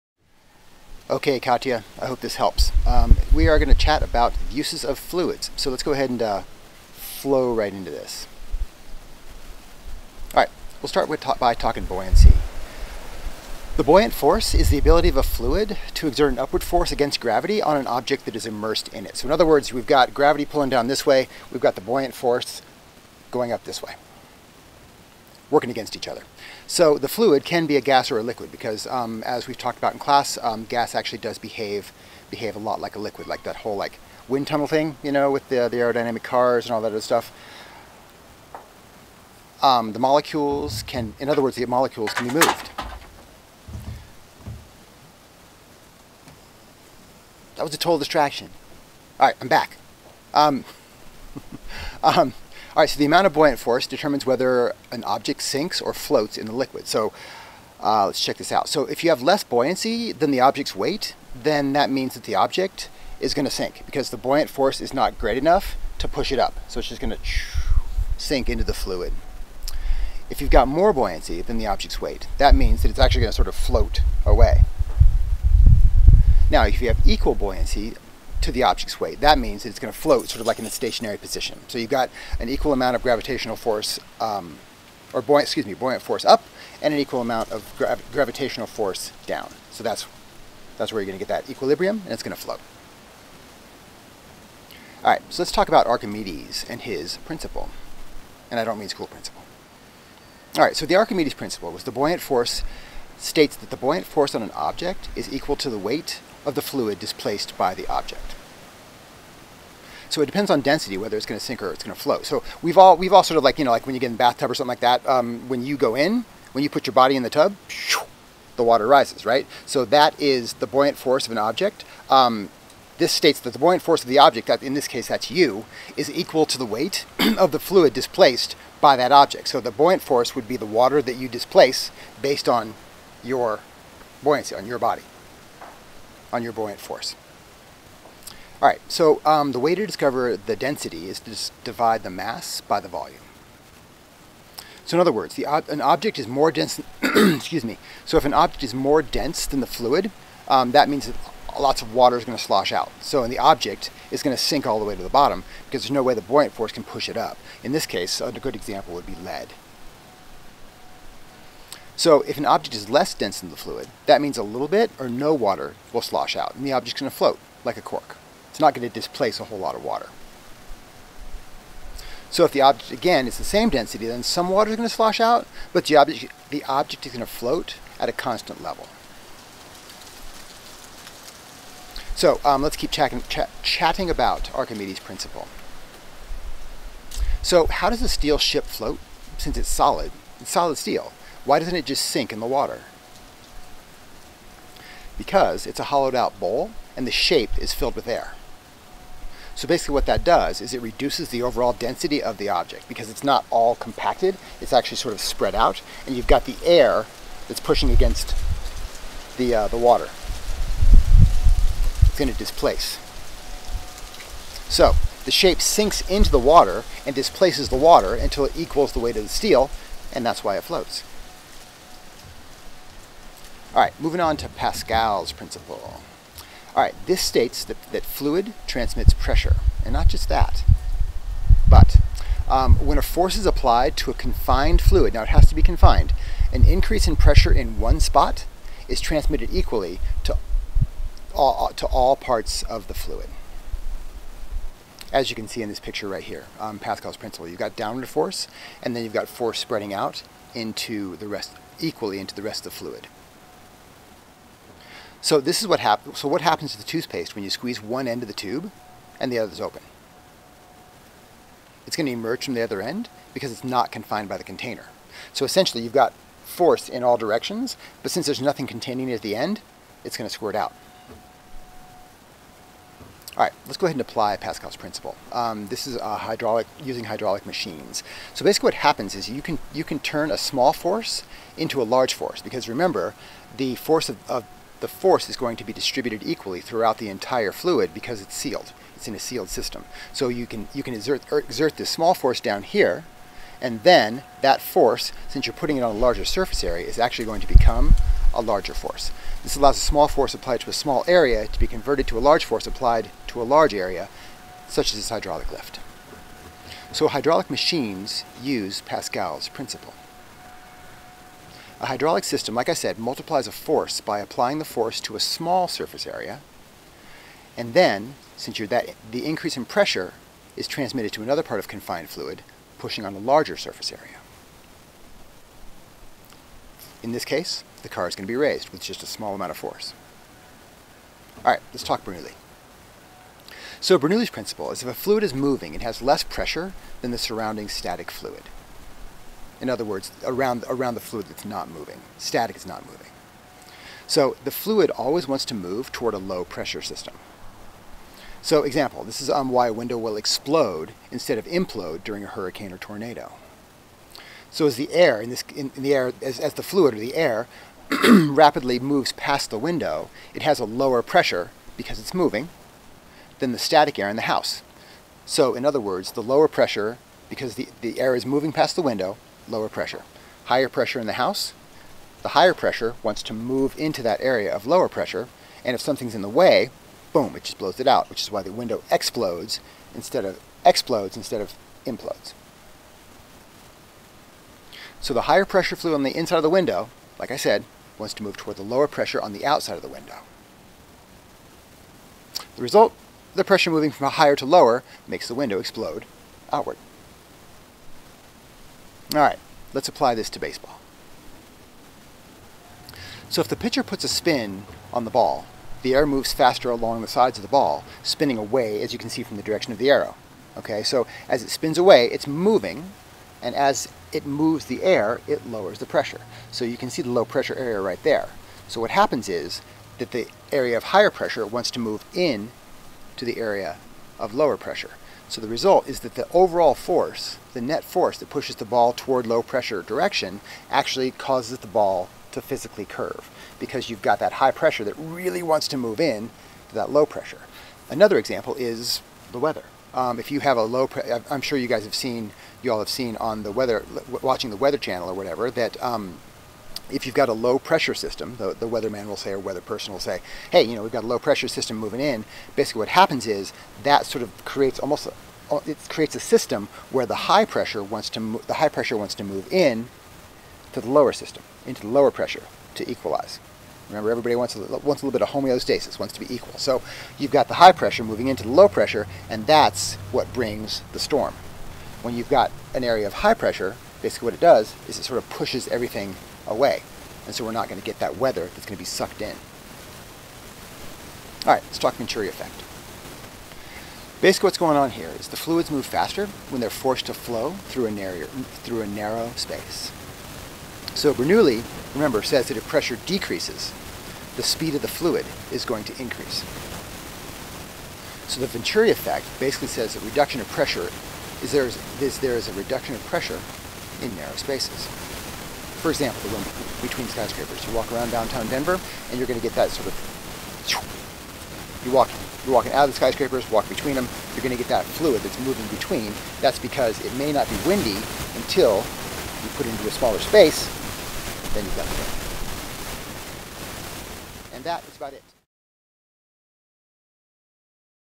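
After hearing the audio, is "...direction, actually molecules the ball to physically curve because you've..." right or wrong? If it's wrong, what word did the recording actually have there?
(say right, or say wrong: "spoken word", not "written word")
wrong: "causes", not "molecules".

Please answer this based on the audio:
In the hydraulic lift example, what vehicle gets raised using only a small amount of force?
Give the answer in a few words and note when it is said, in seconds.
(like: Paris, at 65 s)
The car, at 327 s.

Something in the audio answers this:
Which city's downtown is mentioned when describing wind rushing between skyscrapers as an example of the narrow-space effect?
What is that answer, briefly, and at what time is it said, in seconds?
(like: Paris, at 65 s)
Denver, at 508 s.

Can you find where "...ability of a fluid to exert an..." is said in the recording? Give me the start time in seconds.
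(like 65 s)
14 s.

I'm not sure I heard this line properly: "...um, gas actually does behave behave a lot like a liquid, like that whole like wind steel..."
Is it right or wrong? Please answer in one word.
wrong.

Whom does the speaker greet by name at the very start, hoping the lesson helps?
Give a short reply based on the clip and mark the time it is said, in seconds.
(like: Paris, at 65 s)
Katya, at 1 s.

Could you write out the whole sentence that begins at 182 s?
So um, let's keep chatting, ch chatting about Archimedes' principle.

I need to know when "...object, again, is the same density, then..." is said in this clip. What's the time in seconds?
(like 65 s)
172 s.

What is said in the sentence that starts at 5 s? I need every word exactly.
So let's go ahead and uh, flow right into this.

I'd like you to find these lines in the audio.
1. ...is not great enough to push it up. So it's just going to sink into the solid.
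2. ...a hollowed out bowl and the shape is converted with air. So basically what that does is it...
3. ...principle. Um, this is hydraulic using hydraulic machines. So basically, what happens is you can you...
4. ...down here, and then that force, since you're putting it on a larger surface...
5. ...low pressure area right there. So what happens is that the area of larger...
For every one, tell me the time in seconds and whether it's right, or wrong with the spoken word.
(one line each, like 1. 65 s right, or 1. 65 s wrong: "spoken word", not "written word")
1. 64 s wrong: "fluid", not "solid"
2. 195 s wrong: "filled", not "converted"
3. 274 s right
4. 292 s right
5. 417 s wrong: "higher", not "larger".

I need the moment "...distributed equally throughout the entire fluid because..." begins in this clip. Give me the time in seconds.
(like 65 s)
285 s.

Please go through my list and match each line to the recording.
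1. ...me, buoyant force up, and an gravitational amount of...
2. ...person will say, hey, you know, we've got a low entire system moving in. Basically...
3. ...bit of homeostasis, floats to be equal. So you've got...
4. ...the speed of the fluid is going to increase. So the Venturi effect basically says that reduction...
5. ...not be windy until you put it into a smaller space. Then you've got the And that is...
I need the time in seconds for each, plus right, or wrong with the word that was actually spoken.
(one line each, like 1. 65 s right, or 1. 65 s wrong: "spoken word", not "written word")
1. 85 s wrong: "equal", not "gravitational"
2. 449 s wrong: "pressure", not "entire"
3. 465 s wrong: "wants", not "floats"
4. 494 s right
5. 517 s right.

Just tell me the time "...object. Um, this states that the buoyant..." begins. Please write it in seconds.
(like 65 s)
121 s.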